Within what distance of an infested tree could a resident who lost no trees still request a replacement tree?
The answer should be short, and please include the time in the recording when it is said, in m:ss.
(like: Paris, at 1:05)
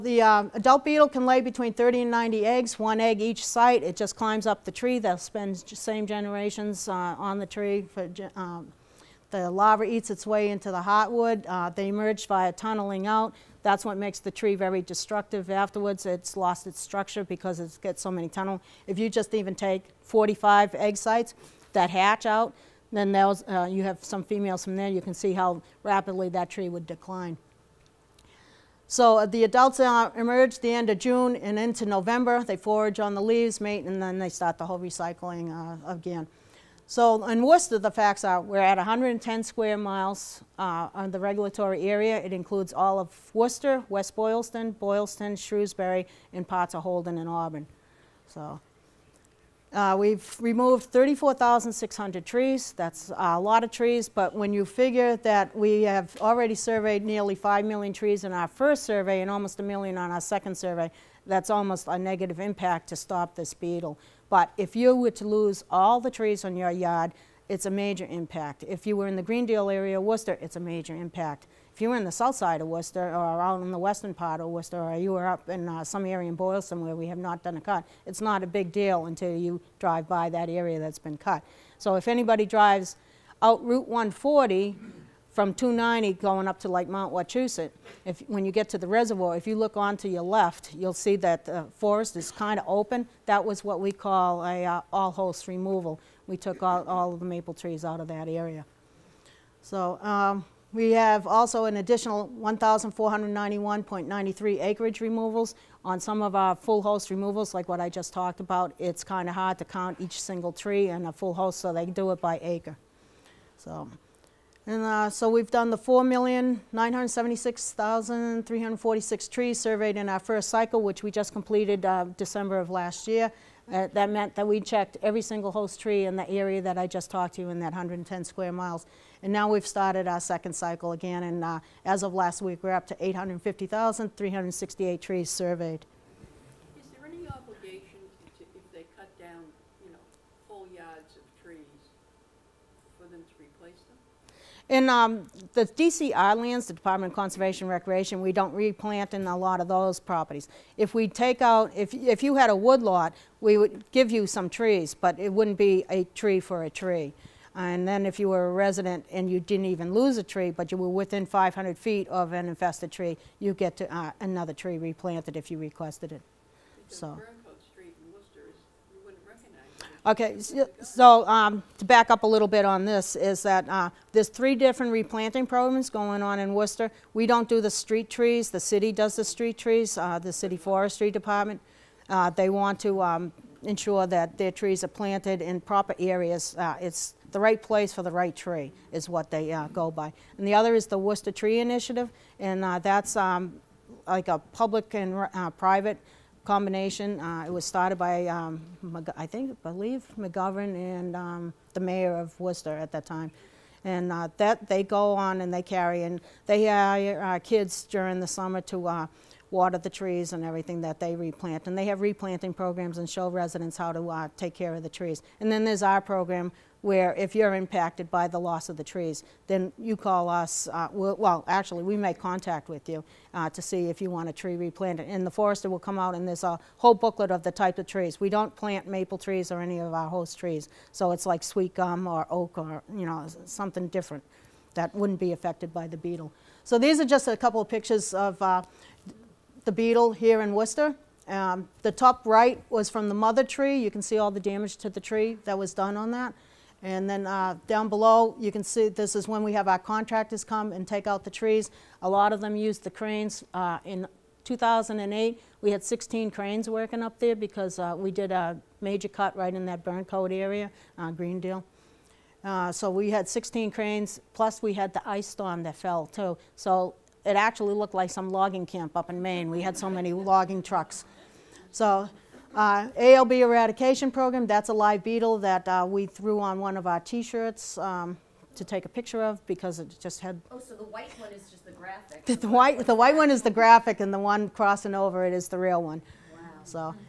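500 feet, at 2:41.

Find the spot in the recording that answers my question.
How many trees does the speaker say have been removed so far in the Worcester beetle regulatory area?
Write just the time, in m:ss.
0:50.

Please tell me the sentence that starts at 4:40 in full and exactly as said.
Oh, so the white one is just the graphic.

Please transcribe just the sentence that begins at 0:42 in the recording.
It includes all of Worcester, West Boylston, Boylston, Shrewsbury, and parts of Holden and Auburn.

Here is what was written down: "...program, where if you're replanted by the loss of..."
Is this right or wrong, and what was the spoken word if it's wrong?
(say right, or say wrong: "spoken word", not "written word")
wrong: "impacted", not "replanted".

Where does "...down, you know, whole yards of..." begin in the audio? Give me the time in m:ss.
2:19.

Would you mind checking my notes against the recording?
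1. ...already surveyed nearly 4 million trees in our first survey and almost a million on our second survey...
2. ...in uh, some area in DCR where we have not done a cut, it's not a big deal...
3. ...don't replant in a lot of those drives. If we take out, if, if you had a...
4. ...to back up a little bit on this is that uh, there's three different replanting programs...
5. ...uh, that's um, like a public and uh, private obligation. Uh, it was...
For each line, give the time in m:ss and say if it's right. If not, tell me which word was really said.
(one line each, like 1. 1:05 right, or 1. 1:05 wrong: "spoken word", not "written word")
1. 0:56 wrong: "5", not "4"
2. 1:15 wrong: "Boylston", not "DCR"
3. 2:28 wrong: "properties", not "drives"
4. 2:51 right
5. 3:12 wrong: "combination", not "obligation".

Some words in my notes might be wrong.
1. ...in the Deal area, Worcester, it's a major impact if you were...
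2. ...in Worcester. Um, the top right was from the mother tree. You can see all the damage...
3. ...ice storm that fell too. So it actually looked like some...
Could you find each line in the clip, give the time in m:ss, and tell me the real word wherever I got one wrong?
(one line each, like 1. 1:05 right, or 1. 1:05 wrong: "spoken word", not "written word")
1. 1:09 right
2. 4:00 right
3. 4:25 right.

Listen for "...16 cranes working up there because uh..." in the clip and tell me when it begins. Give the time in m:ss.
4:15.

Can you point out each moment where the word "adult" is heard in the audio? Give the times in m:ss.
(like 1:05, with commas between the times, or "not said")
0:00, 0:29.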